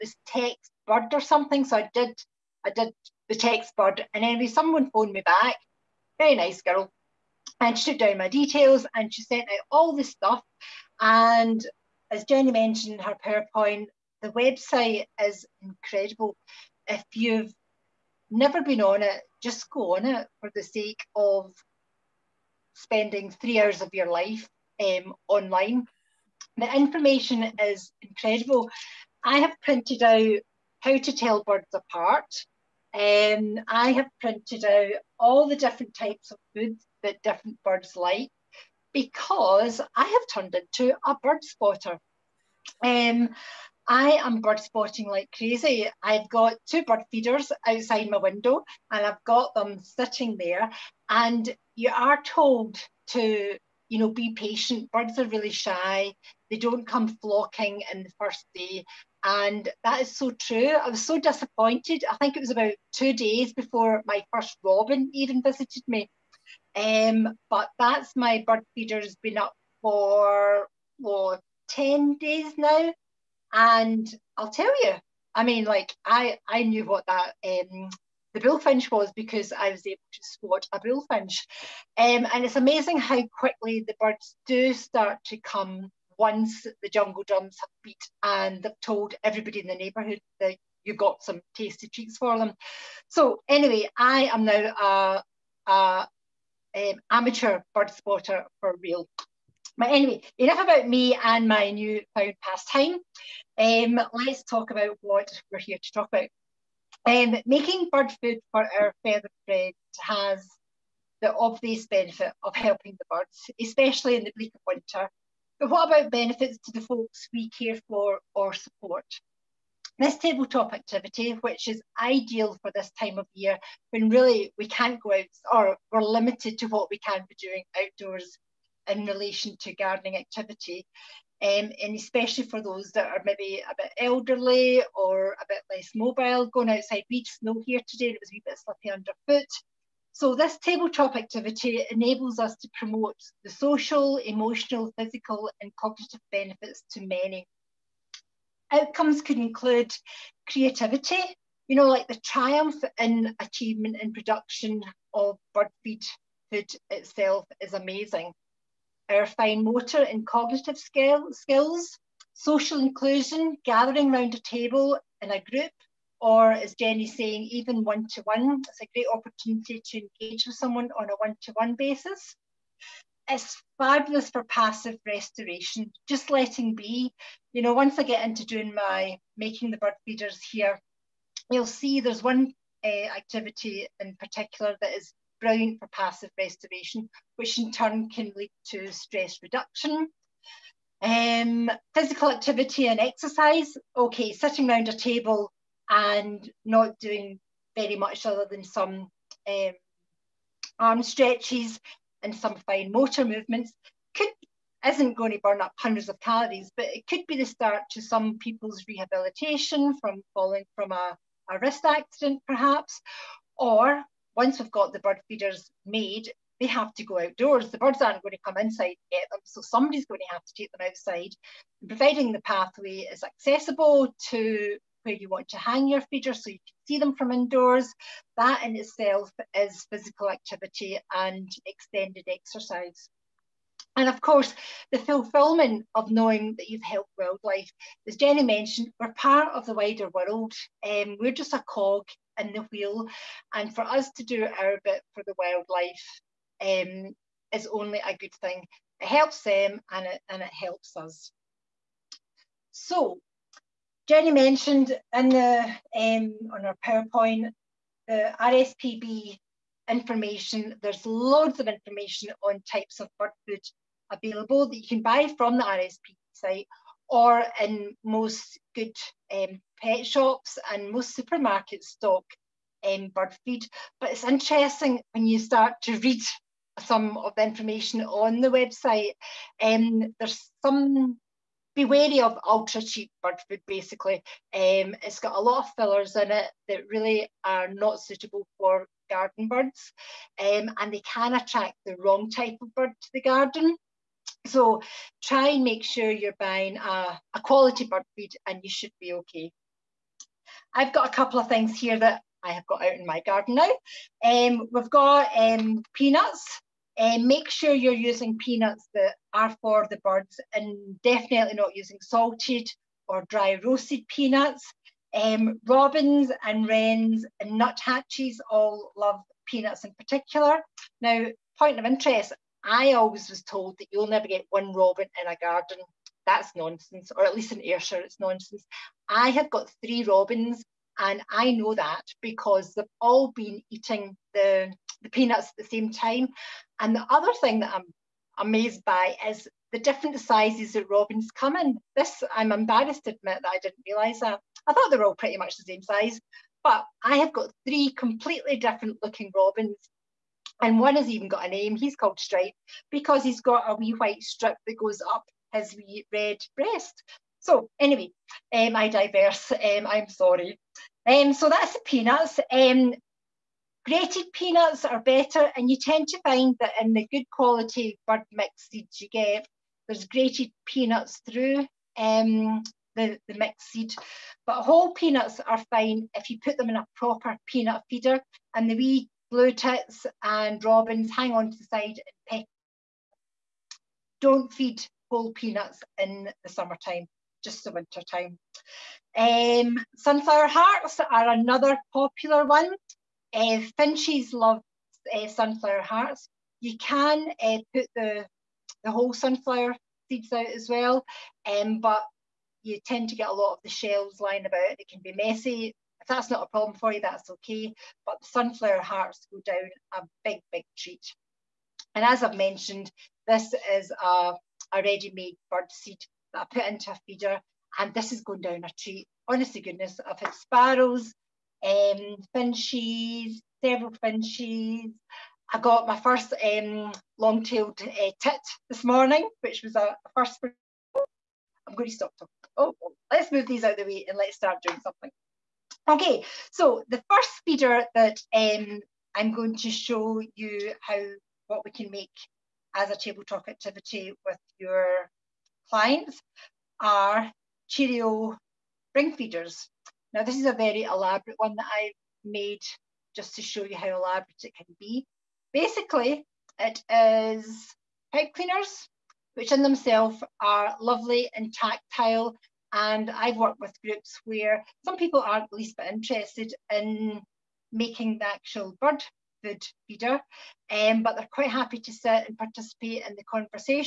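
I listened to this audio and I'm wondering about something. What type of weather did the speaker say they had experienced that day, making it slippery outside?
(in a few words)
Snow.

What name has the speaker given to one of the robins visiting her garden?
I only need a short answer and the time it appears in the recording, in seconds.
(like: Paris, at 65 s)
Stripe, at 352 s.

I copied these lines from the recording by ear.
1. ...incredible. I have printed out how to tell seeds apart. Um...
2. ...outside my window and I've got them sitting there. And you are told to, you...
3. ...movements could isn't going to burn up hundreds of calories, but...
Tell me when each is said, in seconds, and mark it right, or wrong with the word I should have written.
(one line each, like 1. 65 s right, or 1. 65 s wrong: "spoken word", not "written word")
1. 28 s wrong: "birds", not "seeds"
2. 47 s right
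3. 203 s right.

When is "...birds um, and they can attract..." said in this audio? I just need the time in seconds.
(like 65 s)
289 s.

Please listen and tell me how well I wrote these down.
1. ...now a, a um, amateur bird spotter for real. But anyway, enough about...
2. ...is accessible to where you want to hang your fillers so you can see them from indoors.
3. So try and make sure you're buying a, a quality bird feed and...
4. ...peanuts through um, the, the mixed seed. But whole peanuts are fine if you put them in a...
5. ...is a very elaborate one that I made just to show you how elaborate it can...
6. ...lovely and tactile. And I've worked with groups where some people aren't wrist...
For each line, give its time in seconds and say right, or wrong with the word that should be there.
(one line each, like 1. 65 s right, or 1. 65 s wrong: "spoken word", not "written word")
1. 94 s right
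2. 223 s wrong: "feeders", not "fillers"
3. 294 s right
4. 370 s right
5. 450 s right
6. 460 s wrong: "least", not "wrist".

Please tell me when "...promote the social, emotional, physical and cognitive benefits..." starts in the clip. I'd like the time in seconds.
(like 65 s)
142 s.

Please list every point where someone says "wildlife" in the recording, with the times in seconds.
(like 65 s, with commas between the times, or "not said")
237 s, 245 s.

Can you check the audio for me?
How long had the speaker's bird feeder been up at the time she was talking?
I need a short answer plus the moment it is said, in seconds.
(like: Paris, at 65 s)
10 days, at 71 s.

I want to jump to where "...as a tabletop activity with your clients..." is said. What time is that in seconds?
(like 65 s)
442 s.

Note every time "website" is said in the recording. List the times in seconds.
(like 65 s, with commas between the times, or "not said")
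14 s, 278 s.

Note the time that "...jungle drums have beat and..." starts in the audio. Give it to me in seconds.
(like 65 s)
86 s.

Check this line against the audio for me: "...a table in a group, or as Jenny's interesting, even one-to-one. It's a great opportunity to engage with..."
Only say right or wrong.
wrong.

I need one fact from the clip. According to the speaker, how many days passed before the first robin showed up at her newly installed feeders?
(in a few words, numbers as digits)
2.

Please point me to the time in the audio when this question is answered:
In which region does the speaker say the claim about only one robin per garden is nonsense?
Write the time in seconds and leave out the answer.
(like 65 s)
327 s.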